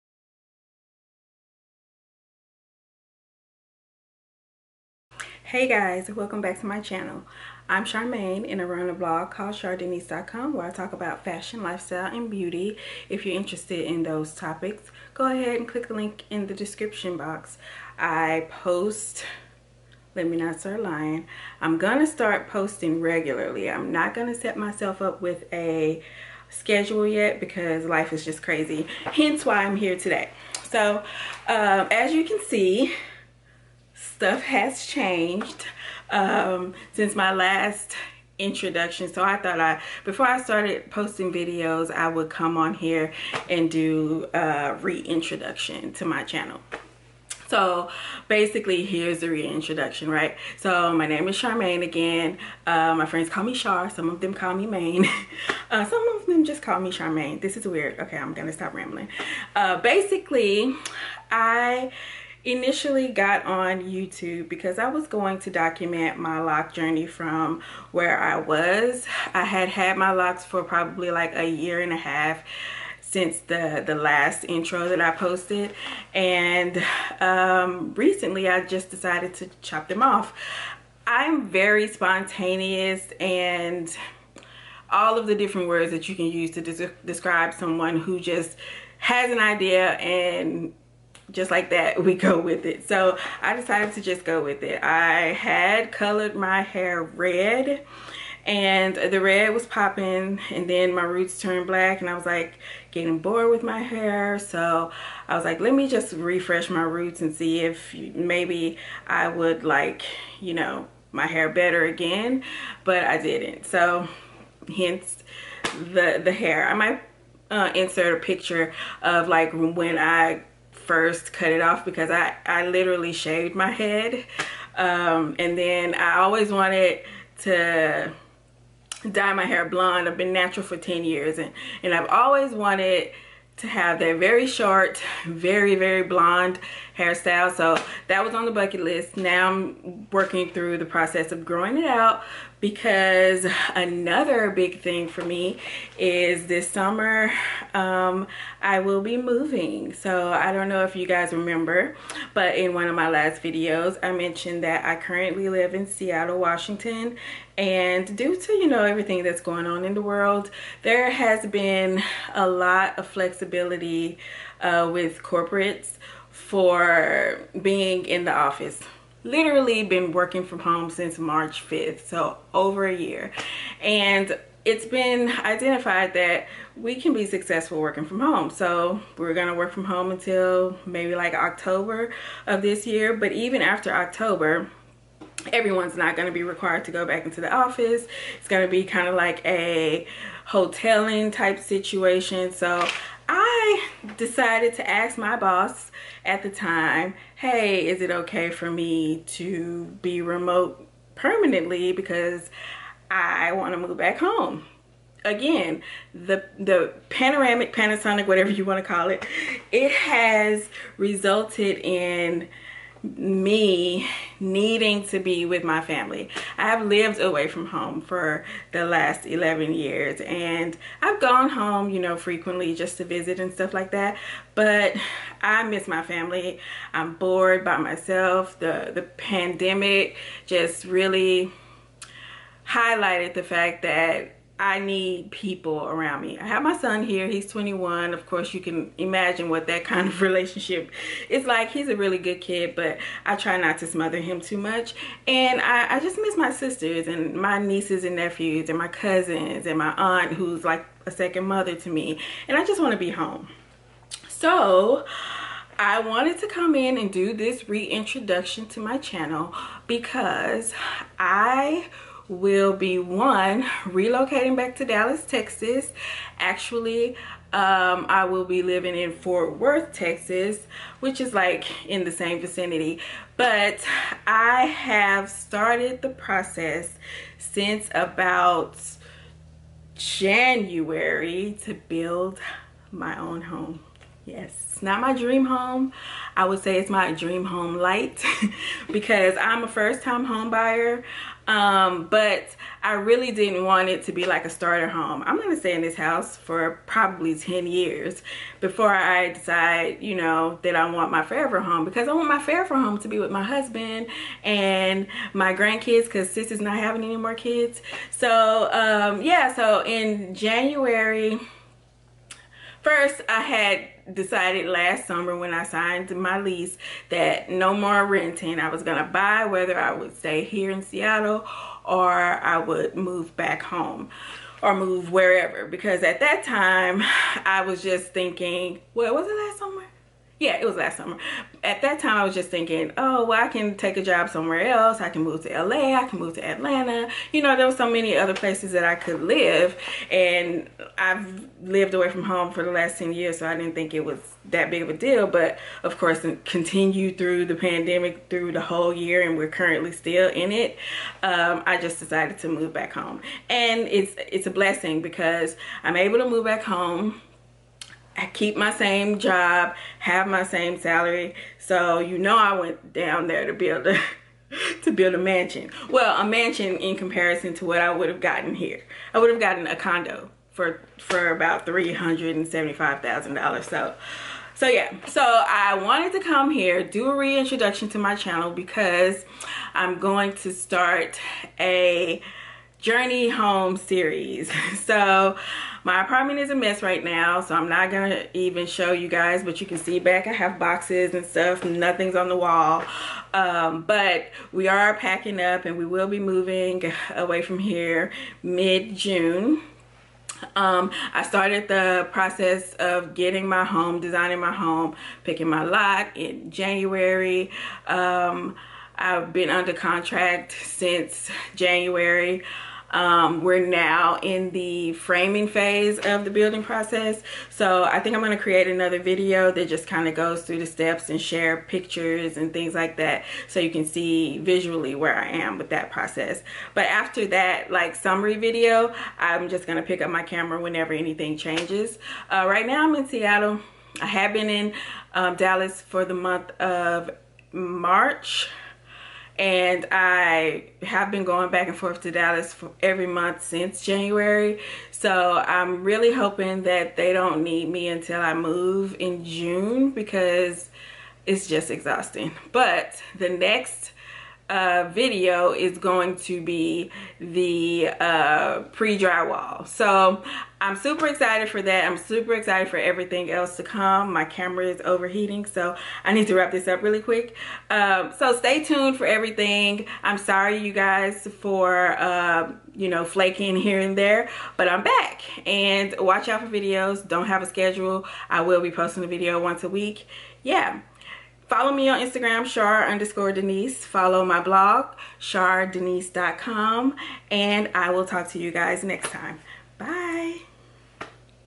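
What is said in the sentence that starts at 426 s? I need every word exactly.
But after that, like summary video, I'm just going to pick up my camera whenever anything changes.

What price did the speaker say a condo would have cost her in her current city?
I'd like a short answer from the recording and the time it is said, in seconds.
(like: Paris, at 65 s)
$375,000, at 371 s.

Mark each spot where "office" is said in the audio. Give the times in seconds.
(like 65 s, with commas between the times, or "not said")
168 s, 187 s.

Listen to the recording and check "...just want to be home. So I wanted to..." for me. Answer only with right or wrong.
right.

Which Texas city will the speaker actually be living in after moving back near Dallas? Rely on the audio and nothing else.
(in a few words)
Fort Worth.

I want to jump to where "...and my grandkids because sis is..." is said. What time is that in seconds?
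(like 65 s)
304 s.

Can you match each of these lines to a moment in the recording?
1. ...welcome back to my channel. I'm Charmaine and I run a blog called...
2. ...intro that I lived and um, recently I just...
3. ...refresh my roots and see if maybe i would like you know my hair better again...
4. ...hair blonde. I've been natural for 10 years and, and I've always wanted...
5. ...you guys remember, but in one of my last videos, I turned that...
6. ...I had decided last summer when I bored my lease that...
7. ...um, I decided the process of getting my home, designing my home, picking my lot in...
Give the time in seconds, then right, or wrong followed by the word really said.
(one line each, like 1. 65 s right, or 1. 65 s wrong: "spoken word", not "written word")
1. 6 s right
2. 74 s wrong: "posted", not "lived"
3. 106 s right
4. 129 s right
5. 150 s wrong: "mentioned", not "turned"
6. 313 s wrong: "signed", not "bored"
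7. 400 s wrong: "started", not "decided".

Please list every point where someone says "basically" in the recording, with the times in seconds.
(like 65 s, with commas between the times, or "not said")
48 s, 59 s.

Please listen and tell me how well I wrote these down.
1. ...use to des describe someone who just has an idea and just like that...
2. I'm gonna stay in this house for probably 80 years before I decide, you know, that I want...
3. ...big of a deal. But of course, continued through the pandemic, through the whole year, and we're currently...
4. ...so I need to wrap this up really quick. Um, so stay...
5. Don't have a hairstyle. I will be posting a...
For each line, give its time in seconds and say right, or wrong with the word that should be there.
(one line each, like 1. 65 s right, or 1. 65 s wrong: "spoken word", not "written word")
1. 86 s right
2. 295 s wrong: "10", not "80"
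3. 344 s right
4. 465 s right
5. 477 s wrong: "schedule", not "hairstyle".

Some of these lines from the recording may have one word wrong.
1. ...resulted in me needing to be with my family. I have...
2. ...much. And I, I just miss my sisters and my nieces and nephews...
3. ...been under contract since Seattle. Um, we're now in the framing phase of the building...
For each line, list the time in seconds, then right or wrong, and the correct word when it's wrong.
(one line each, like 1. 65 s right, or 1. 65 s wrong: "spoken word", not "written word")
1. 210 s right
2. 244 s right
3. 409 s wrong: "January", not "Seattle".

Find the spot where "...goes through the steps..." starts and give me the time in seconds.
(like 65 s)
420 s.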